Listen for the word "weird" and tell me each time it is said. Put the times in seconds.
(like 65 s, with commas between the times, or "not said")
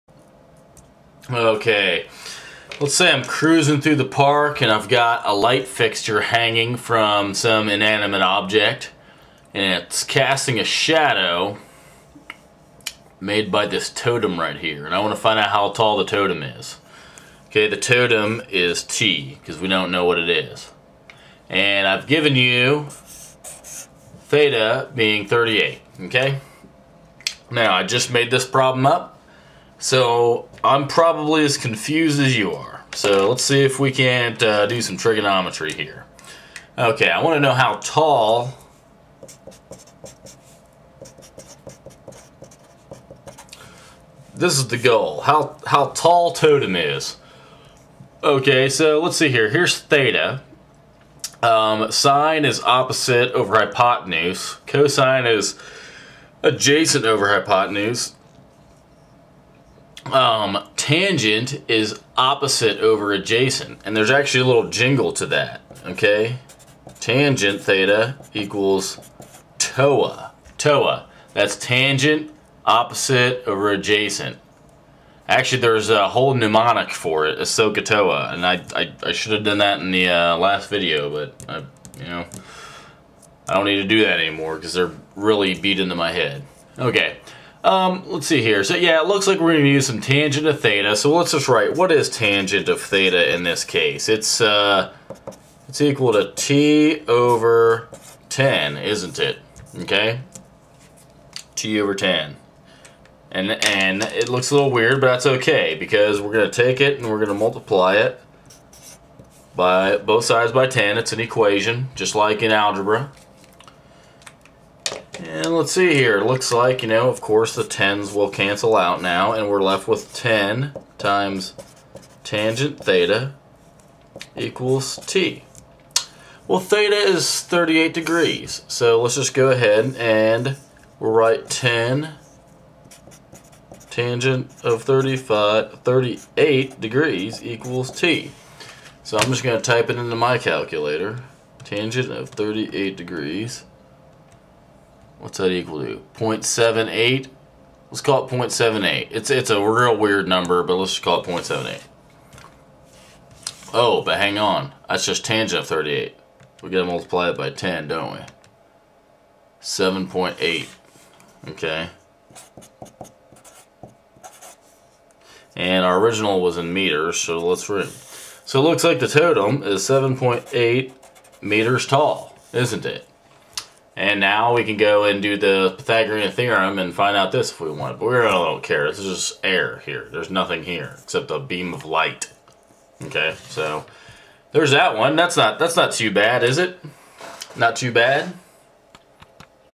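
104 s, 149 s.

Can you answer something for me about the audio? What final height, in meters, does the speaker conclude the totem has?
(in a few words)
7.8 meters.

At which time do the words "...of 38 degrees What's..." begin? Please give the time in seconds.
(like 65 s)
142 s.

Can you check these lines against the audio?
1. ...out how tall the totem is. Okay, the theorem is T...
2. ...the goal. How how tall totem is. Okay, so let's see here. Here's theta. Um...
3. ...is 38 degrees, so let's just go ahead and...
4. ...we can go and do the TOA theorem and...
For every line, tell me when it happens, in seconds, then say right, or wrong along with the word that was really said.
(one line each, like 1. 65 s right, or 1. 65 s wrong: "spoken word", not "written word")
1. 15 s wrong: "totem", not "theorem"
2. 44 s right
3. 126 s right
4. 174 s wrong: "Pythagorean", not "TOA".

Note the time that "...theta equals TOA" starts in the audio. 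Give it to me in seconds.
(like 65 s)
67 s.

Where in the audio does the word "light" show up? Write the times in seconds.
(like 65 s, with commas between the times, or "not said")
5 s, 181 s.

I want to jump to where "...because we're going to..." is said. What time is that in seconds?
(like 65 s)
105 s.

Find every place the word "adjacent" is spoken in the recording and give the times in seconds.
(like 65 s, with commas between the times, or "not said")
56 s, 63 s, 73 s.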